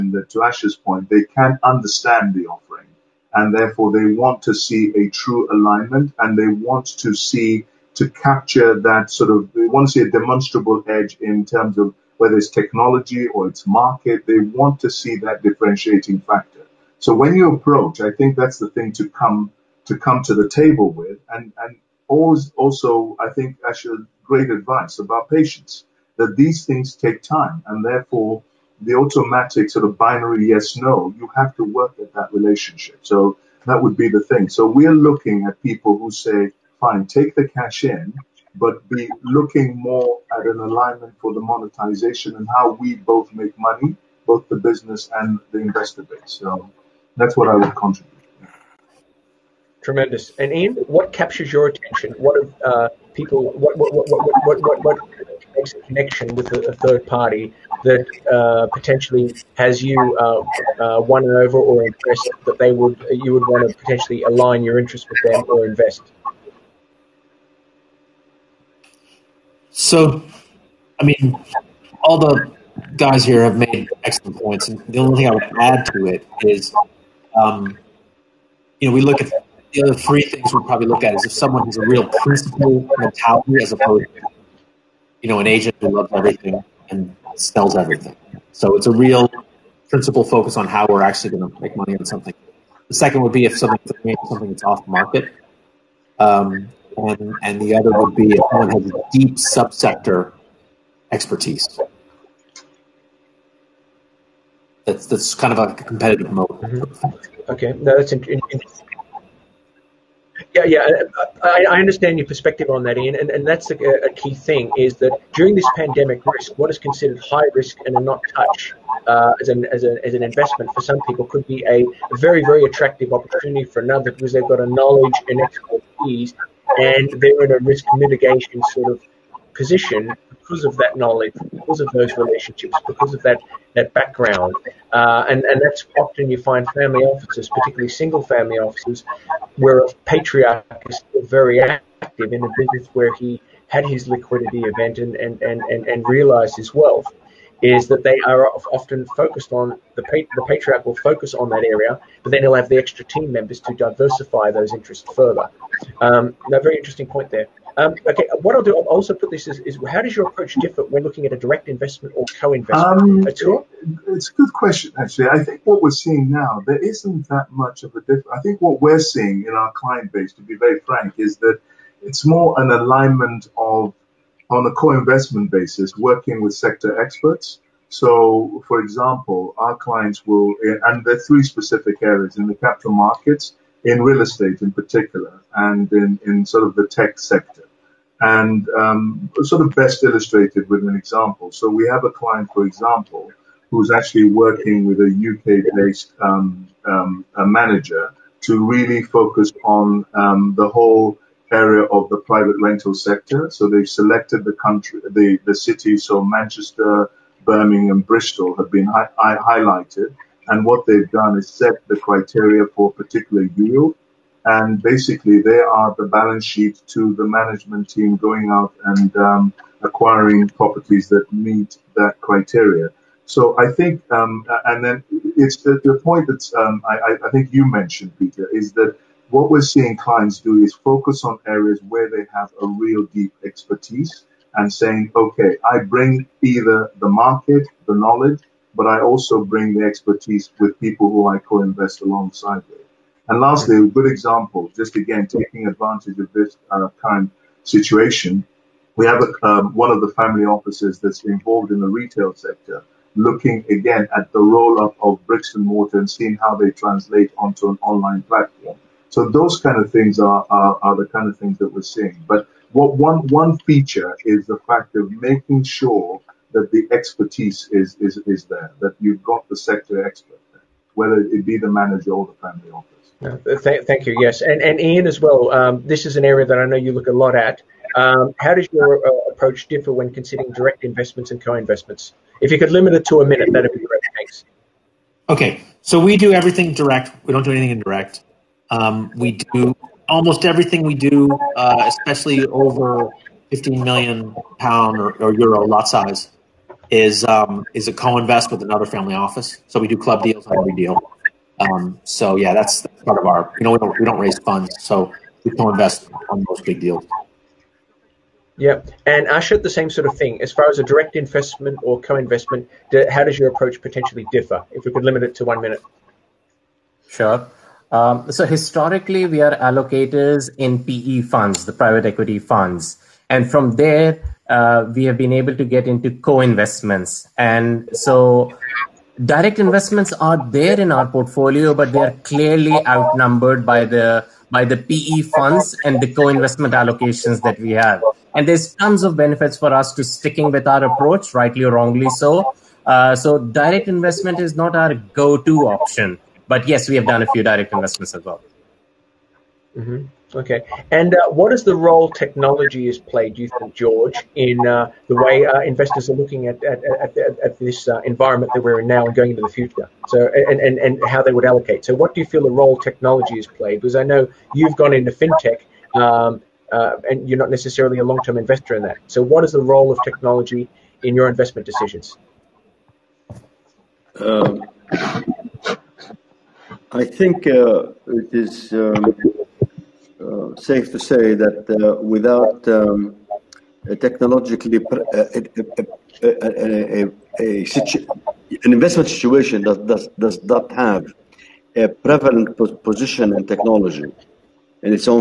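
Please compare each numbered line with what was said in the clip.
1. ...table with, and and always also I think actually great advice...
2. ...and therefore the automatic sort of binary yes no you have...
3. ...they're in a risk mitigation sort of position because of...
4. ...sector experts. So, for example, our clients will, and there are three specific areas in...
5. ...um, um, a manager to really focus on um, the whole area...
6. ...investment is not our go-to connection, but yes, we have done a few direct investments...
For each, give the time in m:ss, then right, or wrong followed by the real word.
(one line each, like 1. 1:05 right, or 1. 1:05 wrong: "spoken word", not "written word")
1. 0:20 right
2. 0:27 right
3. 2:07 right
4. 2:56 right
5. 3:16 right
6. 5:43 wrong: "option", not "connection".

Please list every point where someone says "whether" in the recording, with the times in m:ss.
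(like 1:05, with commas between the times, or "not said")
0:12, 4:30.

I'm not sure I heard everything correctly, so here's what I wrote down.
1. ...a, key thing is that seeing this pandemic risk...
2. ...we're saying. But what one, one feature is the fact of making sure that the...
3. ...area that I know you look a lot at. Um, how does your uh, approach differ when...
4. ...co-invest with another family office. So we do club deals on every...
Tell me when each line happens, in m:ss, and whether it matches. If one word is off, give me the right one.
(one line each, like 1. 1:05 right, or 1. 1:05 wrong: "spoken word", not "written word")
1. 1:54 wrong: "during", not "seeing"
2. 4:21 wrong: "seeing", not "saying"
3. 4:36 right
4. 4:57 right.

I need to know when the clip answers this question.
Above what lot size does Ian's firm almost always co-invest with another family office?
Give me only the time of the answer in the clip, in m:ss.
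4:53.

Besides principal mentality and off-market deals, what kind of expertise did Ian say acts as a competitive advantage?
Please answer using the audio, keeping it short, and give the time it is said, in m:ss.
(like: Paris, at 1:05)
Deep subsector expertise, at 1:39.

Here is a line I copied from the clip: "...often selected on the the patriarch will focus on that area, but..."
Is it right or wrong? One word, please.
wrong.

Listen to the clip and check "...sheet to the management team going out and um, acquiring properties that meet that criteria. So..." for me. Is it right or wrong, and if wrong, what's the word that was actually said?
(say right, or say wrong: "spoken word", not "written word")
right.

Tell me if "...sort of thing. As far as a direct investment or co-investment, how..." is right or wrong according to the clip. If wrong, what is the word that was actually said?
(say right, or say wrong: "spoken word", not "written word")
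right.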